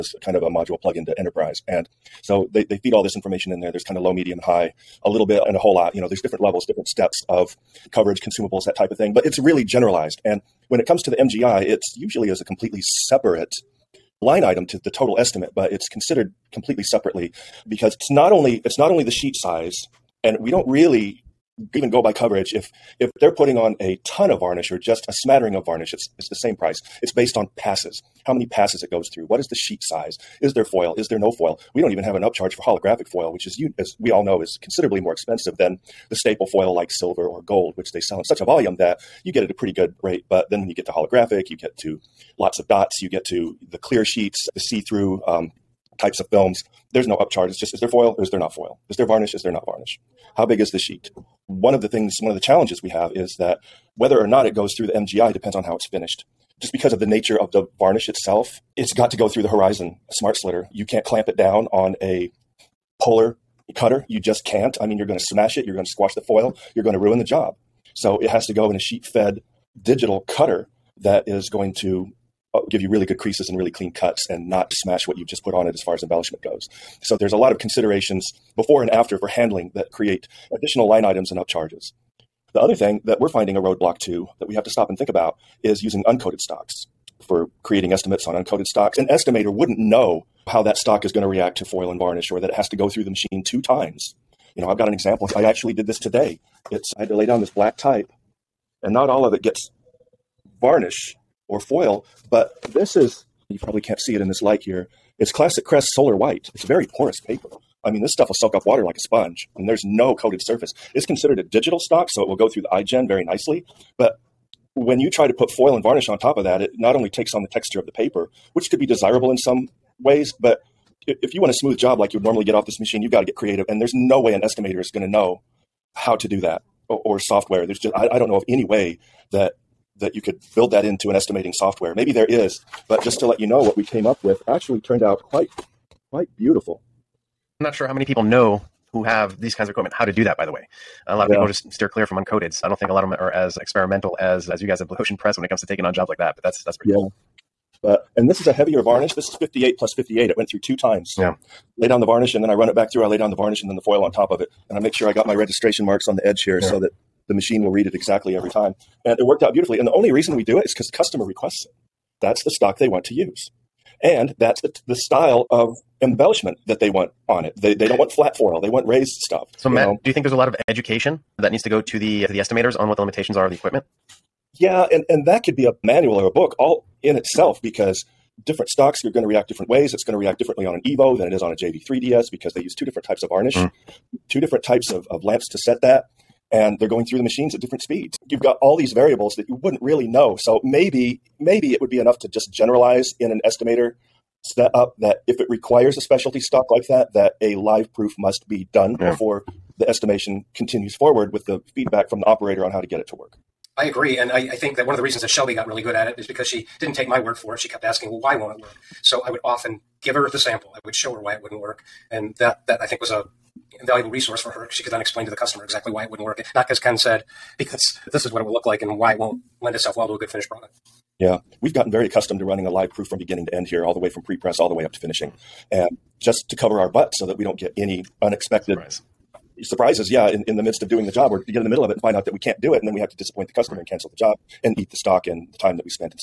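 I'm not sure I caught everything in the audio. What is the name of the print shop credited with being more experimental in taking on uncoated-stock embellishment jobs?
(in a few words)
Blue Ocean Press.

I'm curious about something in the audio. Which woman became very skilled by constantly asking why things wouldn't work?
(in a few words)
Chelby.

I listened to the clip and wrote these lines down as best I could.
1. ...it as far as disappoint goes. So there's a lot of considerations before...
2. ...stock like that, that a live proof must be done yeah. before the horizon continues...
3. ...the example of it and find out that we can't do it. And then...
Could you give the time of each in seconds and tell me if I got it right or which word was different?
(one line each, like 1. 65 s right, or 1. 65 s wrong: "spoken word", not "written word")
1. 75 s wrong: "embellishment", not "disappoint"
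2. 196 s wrong: "estimation", not "horizon"
3. 231 s wrong: "middle", not "example".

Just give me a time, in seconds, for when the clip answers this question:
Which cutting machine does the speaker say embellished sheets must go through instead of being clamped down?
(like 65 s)
59 s.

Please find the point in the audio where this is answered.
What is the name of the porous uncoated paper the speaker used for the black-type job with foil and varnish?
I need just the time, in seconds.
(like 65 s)
105 s.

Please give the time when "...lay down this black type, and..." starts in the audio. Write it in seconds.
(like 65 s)
97 s.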